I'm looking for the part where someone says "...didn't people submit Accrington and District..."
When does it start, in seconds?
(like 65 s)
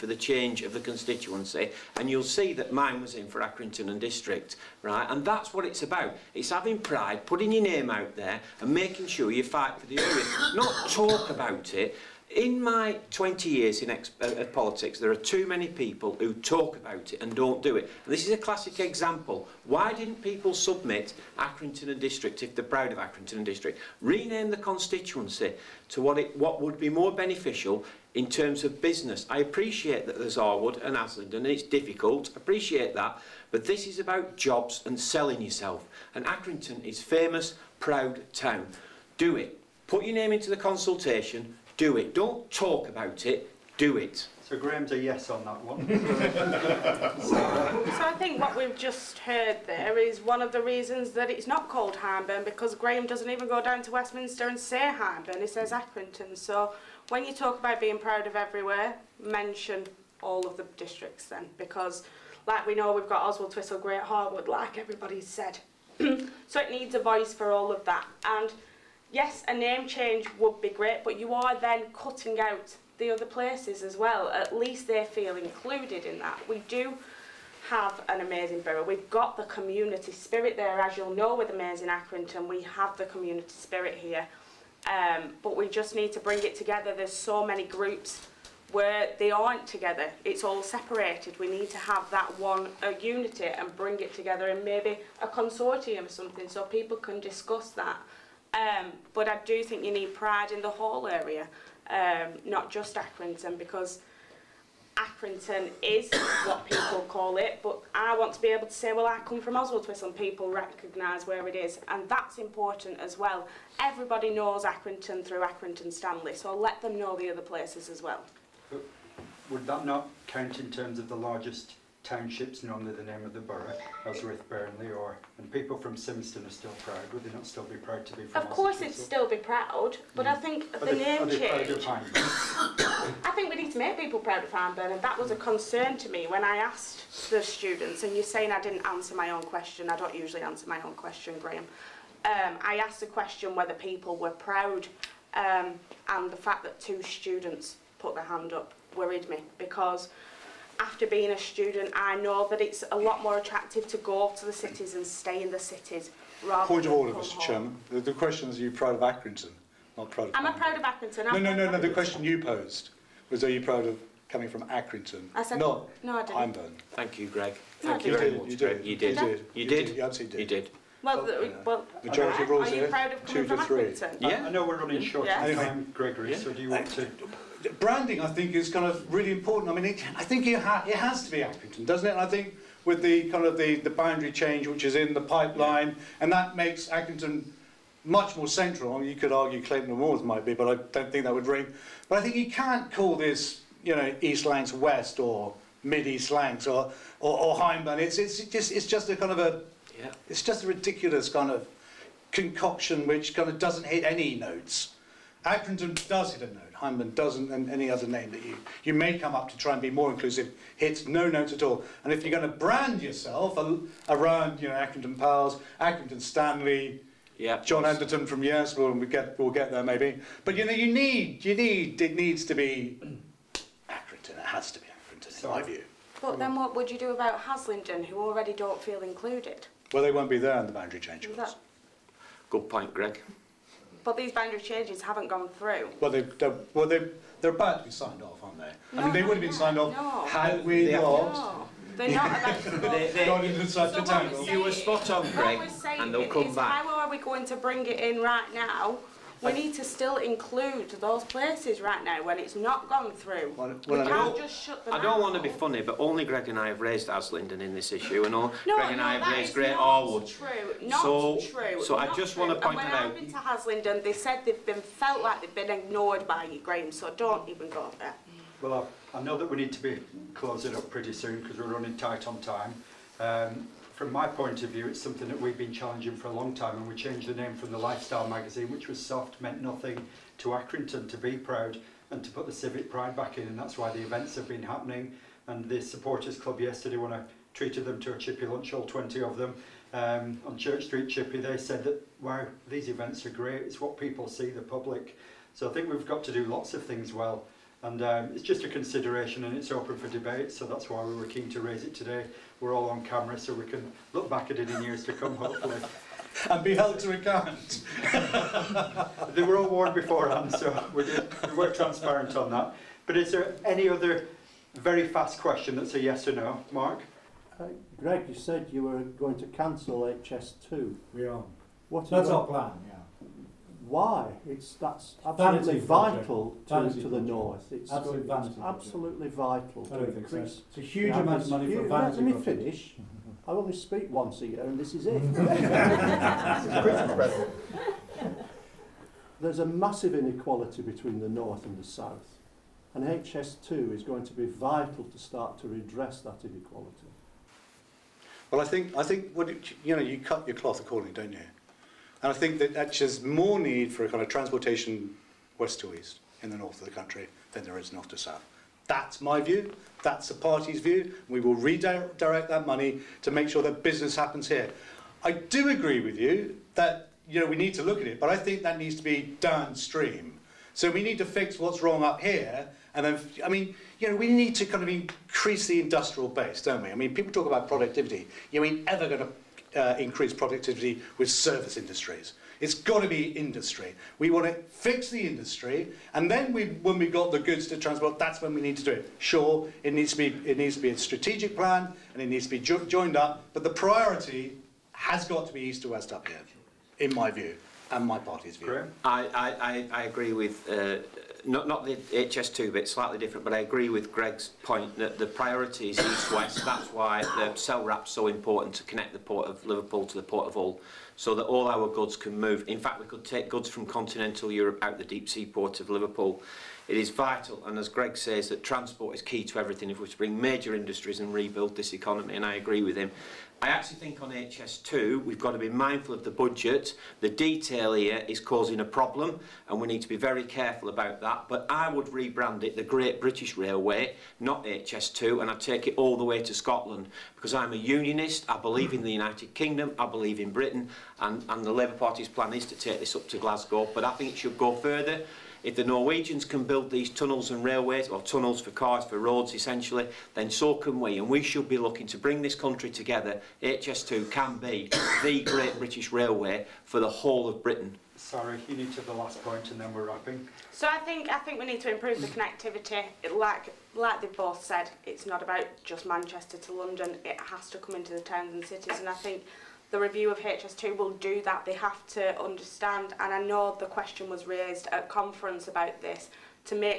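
19 s.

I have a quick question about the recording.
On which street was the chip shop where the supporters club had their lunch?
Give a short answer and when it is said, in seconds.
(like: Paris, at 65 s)
Church Street, at 290 s.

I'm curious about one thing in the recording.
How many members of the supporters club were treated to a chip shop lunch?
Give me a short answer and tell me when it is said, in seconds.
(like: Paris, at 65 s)
20, at 288 s.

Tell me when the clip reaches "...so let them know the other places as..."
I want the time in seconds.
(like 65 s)
116 s.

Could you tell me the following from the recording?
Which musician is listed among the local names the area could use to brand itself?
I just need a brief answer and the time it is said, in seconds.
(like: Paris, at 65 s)
Jon Anderson, at 217 s.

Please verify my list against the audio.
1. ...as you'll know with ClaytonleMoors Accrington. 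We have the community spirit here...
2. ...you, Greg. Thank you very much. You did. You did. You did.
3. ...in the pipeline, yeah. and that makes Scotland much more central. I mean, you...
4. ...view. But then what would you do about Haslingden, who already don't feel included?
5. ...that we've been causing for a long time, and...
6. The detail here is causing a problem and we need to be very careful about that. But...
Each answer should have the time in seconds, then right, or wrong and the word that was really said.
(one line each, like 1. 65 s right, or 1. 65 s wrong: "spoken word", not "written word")
1. 80 s wrong: "Amazing", not "ClaytonleMoors"
2. 167 s right
3. 184 s wrong: "Accrington", not "Scotland"
4. 225 s right
5. 275 s wrong: "challenging", not "causing"
6. 427 s right.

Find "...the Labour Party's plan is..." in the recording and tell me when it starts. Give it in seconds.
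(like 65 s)
441 s.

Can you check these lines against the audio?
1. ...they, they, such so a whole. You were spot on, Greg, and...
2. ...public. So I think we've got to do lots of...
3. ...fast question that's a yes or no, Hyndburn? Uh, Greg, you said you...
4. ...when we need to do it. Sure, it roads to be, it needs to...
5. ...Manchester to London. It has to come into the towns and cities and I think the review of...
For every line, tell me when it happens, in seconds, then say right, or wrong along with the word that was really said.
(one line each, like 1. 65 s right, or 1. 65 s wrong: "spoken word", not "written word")
1. 242 s wrong: "tangle", not "whole"
2. 294 s right
3. 315 s wrong: "Mark", not "Hyndburn"
4. 388 s wrong: "needs", not "roads"
5. 466 s right.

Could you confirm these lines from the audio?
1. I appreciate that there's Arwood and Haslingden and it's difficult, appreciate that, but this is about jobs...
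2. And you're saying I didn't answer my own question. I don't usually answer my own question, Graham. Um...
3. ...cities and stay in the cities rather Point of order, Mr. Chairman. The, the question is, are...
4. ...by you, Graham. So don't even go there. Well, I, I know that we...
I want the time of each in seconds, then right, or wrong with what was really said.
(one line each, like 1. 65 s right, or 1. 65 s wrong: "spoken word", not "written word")
1. 29 s right
2. 138 s right
3. 154 s right
4. 266 s right.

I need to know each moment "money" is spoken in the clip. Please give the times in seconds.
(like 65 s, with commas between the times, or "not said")
331 s, 362 s.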